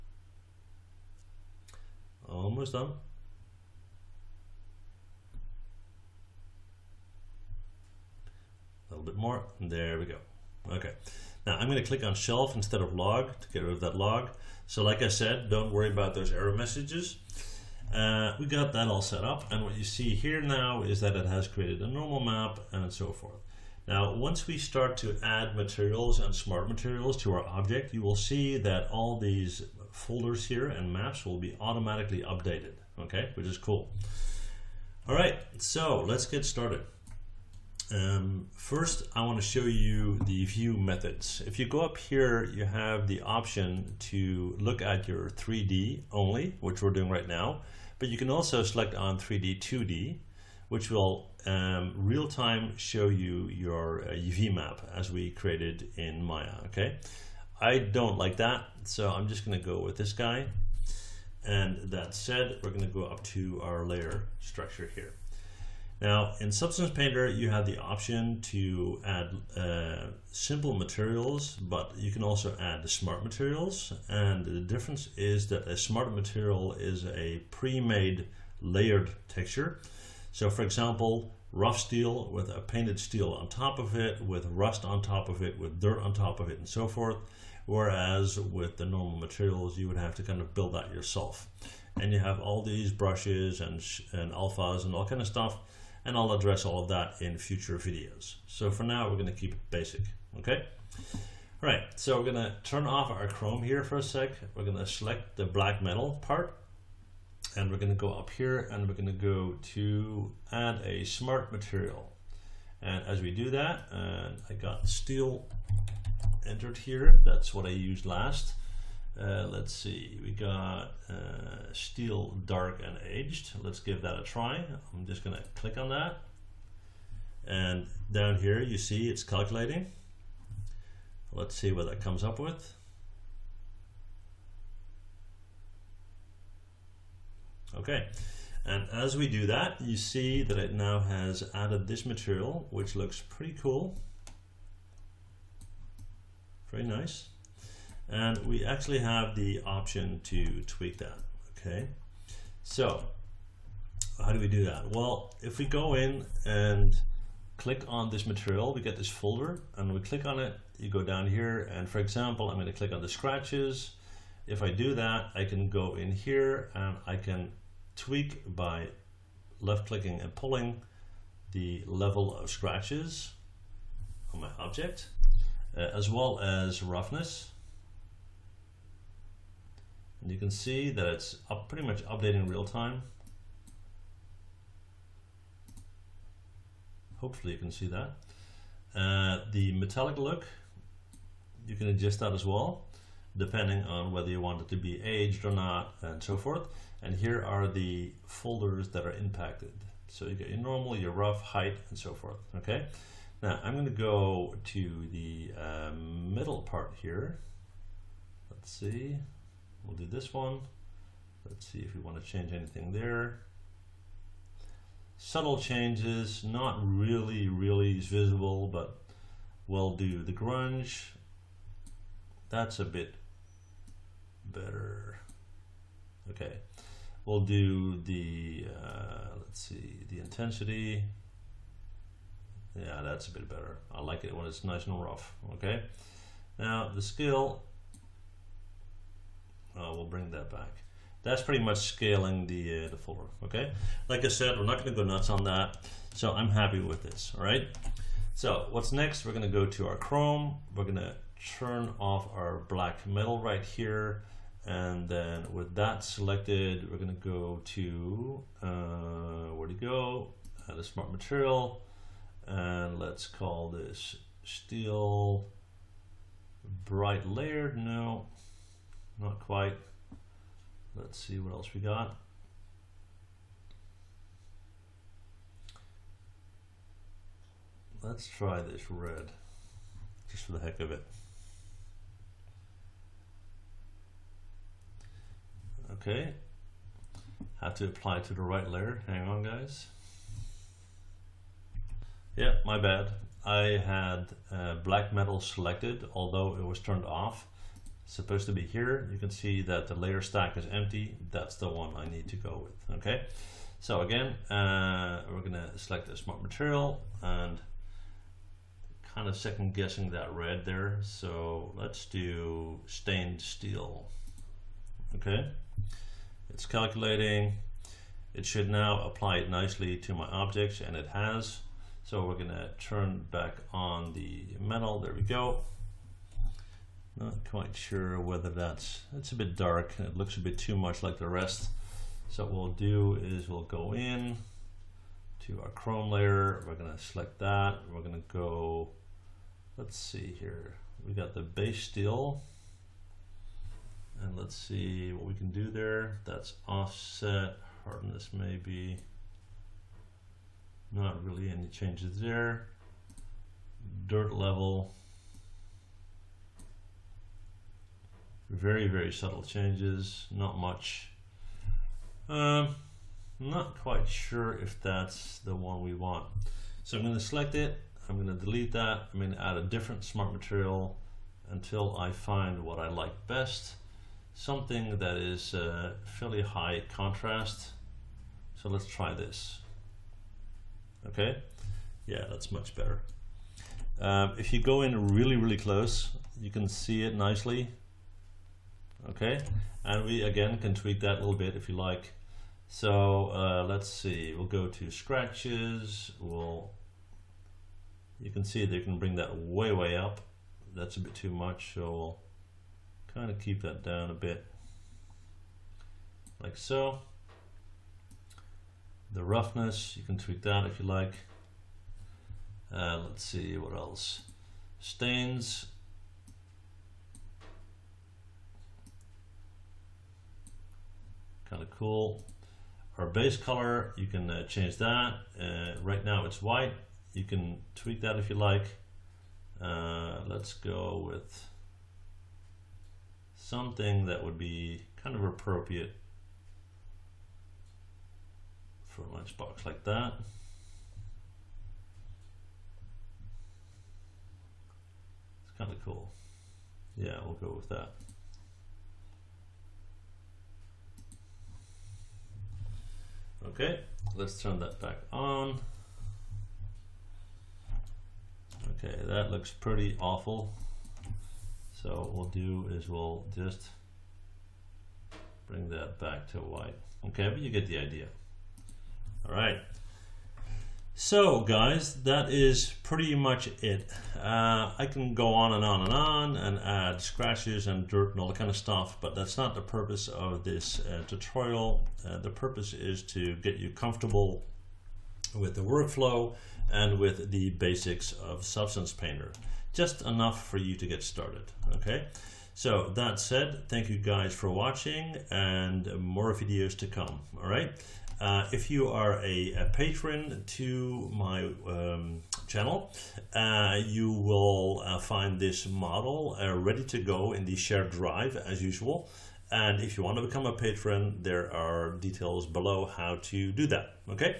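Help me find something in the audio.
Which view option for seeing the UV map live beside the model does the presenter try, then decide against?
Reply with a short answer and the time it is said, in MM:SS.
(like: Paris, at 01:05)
3D 2D, at 00:49.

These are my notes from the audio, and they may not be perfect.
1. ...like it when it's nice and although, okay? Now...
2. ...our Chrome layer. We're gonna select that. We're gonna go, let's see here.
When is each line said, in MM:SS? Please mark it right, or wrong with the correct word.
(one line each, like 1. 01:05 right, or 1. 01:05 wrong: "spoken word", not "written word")
1. 03:54 wrong: "rough", not "although"
2. 05:35 right.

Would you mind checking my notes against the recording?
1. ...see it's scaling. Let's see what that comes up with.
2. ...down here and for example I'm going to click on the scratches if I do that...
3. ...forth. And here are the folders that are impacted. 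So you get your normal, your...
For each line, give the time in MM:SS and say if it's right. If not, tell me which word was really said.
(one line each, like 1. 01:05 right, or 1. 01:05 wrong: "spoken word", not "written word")
1. 02:08 wrong: "calculating", not "scaling"
2. 02:41 right
3. 03:16 right.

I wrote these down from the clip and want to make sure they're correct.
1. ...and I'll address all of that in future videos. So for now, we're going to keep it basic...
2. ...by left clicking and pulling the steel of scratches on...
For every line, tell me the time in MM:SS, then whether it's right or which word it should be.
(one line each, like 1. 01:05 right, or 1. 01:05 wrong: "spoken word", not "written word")
1. 01:36 right
2. 02:48 wrong: "level", not "steel".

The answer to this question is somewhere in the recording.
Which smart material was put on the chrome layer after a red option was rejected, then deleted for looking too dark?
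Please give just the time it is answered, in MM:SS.
05:12.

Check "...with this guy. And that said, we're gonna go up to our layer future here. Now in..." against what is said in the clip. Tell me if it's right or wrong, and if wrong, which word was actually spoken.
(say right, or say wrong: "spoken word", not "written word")
wrong: "structure", not "future".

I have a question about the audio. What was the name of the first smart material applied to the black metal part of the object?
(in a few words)
Steel dark and aged.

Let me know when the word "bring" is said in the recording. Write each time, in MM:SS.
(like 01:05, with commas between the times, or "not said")
04:00, 06:38, 07:45.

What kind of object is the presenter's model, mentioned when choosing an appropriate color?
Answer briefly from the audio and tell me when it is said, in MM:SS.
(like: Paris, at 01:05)
a lunchbox, at 07:19.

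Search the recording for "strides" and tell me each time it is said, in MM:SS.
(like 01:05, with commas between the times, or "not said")
not said.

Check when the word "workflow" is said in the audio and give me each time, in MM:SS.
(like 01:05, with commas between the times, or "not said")
08:05.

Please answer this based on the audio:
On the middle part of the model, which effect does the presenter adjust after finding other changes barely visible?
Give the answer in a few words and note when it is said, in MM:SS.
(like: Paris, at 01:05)
grunge, at 03:40.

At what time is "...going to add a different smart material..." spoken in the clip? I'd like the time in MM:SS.
06:09.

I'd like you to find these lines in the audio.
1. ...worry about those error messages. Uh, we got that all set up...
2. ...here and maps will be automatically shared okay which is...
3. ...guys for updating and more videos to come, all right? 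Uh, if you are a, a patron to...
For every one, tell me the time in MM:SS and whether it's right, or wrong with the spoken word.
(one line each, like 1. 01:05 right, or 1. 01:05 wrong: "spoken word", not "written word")
1. 00:15 right
2. 00:30 wrong: "updated", not "shared"
3. 08:13 wrong: "watching", not "updating".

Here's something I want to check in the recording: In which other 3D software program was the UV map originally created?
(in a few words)
Maya.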